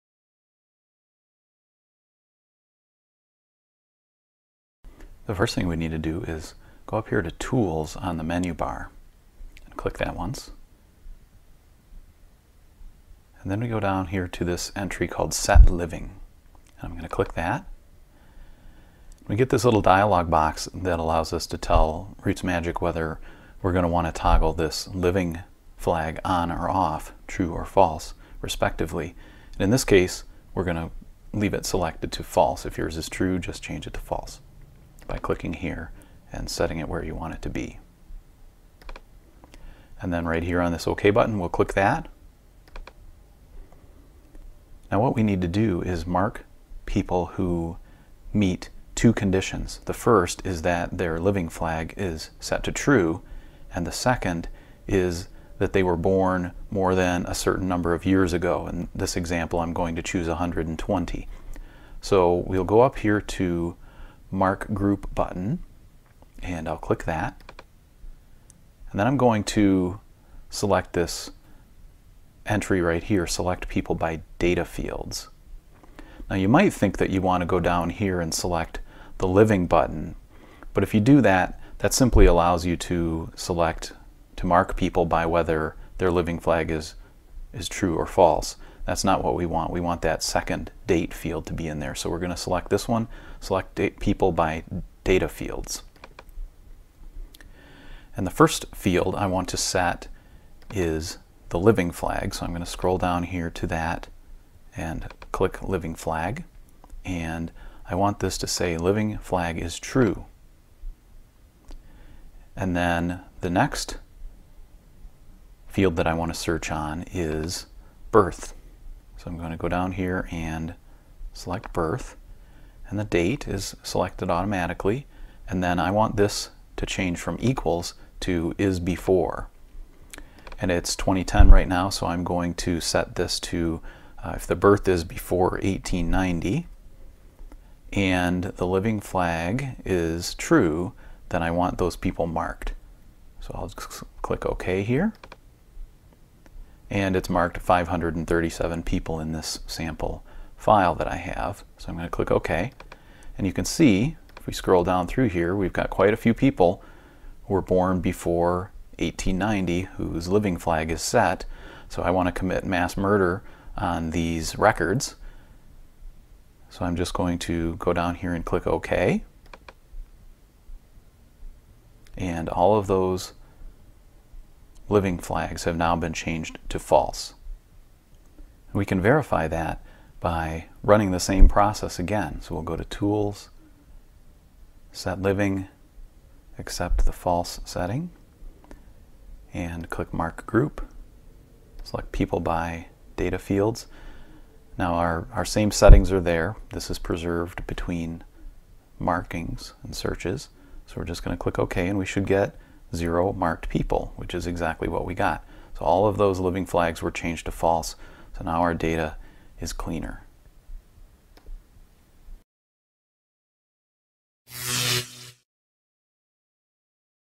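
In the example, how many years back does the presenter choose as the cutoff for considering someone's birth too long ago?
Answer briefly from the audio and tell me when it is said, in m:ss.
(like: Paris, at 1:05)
120, at 1:00.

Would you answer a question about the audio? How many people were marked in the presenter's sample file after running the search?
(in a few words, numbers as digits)
537.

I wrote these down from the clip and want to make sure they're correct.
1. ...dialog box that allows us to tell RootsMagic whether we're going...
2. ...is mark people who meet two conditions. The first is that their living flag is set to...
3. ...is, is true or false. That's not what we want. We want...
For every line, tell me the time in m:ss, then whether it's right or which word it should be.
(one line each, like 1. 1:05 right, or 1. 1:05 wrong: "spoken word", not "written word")
1. 0:19 right
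2. 0:45 right
3. 1:26 right.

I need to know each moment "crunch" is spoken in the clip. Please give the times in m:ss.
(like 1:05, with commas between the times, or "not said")
not said.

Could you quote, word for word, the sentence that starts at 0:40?
And then right here on this OK button, we'll click that.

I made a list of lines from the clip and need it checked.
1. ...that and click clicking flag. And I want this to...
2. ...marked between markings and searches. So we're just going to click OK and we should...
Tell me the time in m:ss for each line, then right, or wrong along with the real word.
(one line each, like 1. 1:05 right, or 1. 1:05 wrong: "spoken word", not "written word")
1. 1:43 wrong: "living", not "clicking"
2. 3:16 wrong: "preserved", not "marked".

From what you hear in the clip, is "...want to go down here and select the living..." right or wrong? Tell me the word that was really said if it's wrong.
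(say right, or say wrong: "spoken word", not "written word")
right.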